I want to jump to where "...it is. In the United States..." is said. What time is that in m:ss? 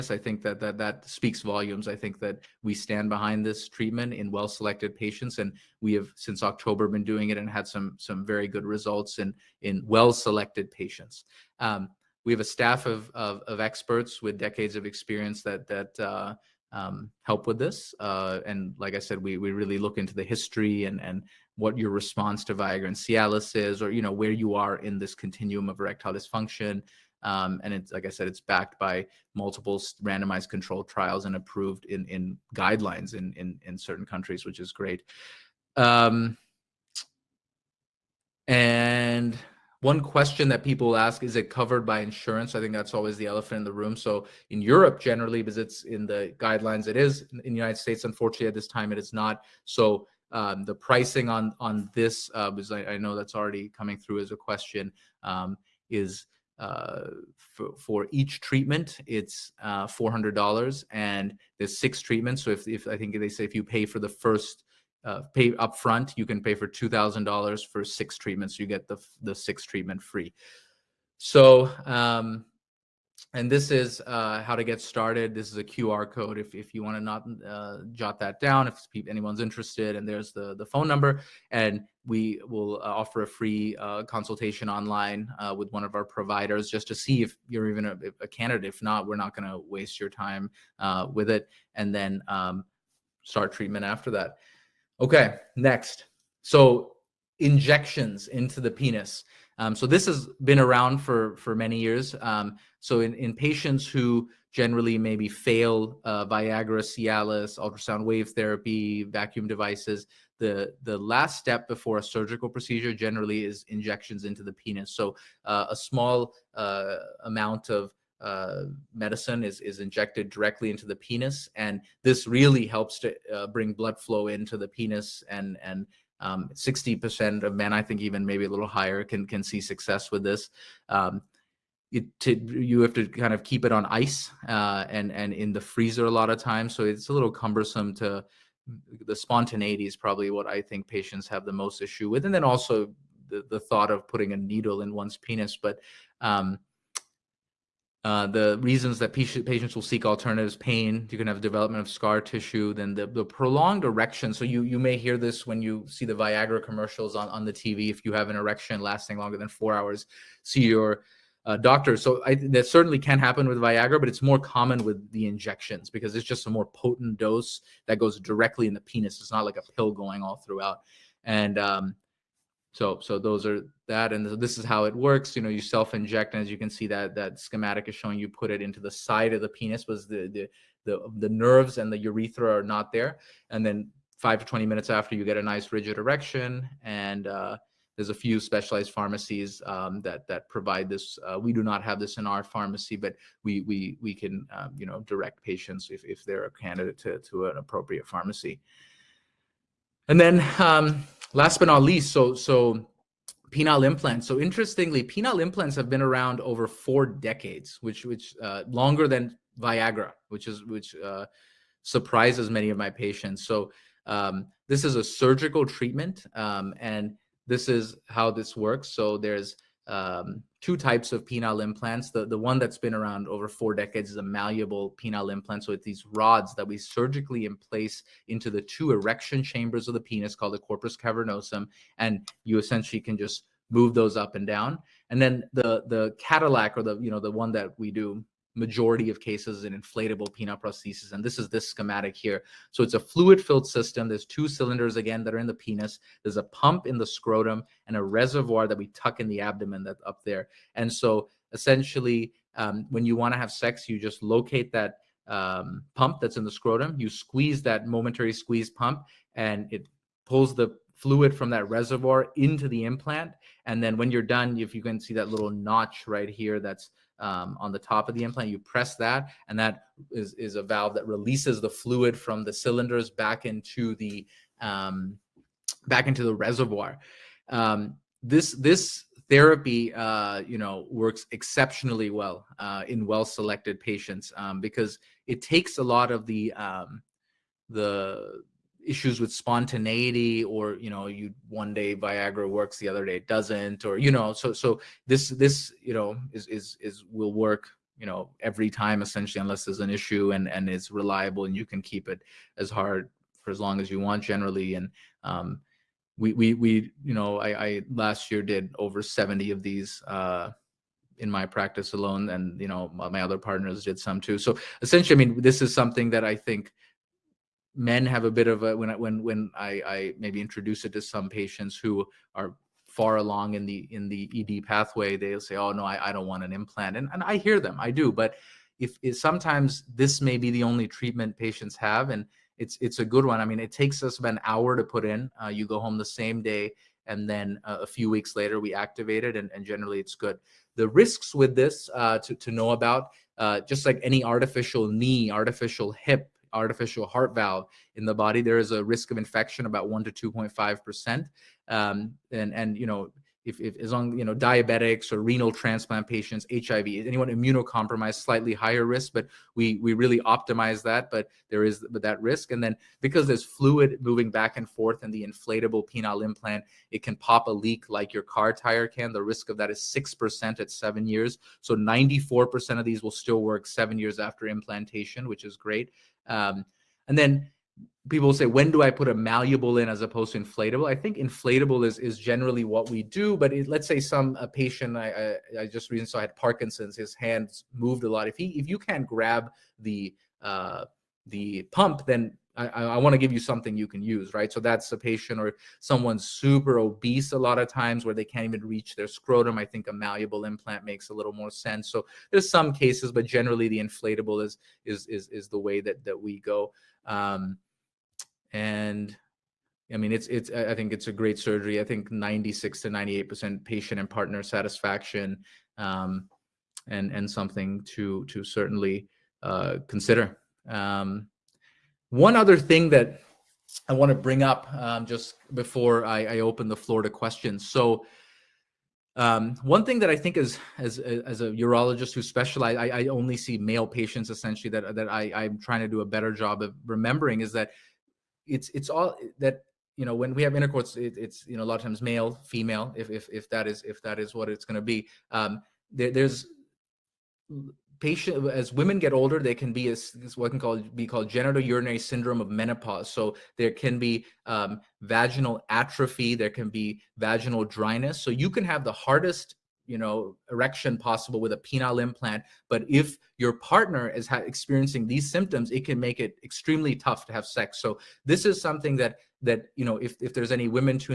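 0:46.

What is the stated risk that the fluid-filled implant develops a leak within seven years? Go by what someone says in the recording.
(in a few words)
6%.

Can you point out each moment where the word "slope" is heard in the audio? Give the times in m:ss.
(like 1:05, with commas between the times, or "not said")
not said.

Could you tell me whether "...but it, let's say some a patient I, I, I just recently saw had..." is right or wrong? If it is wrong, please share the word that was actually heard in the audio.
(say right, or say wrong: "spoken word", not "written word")
right.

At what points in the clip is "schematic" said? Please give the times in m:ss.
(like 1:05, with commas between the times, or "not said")
2:57, 4:01.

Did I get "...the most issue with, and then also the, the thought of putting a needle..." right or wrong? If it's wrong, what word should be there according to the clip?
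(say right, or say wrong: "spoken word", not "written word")
right.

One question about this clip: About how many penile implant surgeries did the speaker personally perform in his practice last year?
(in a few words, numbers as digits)
over 70.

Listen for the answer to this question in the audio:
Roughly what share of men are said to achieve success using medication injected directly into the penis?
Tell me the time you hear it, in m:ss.
2:06.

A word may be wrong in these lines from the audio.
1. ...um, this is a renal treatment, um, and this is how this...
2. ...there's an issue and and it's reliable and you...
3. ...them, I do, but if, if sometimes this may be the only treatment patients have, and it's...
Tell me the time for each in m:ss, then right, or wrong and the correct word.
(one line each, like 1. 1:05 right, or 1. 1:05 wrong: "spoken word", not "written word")
1. 3:34 wrong: "surgical", not "renal"
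2. 4:59 right
3. 5:27 right.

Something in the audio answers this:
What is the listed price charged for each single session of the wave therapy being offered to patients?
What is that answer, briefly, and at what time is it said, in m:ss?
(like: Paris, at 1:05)
$400, at 0:59.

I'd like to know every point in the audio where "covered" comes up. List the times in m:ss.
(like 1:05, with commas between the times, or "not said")
0:41.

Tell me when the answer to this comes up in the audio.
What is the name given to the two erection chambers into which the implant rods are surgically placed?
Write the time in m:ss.
3:50.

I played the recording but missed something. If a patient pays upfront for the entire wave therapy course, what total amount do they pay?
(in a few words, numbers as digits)
$2,000.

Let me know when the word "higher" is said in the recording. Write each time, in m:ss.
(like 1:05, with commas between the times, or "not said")
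2:08, 5:58.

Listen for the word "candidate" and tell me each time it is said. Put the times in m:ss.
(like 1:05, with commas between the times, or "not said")
1:28, 3:16.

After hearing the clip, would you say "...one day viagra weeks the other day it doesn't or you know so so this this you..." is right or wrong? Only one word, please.
wrong.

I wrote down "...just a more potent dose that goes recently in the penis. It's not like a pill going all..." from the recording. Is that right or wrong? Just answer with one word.
wrong.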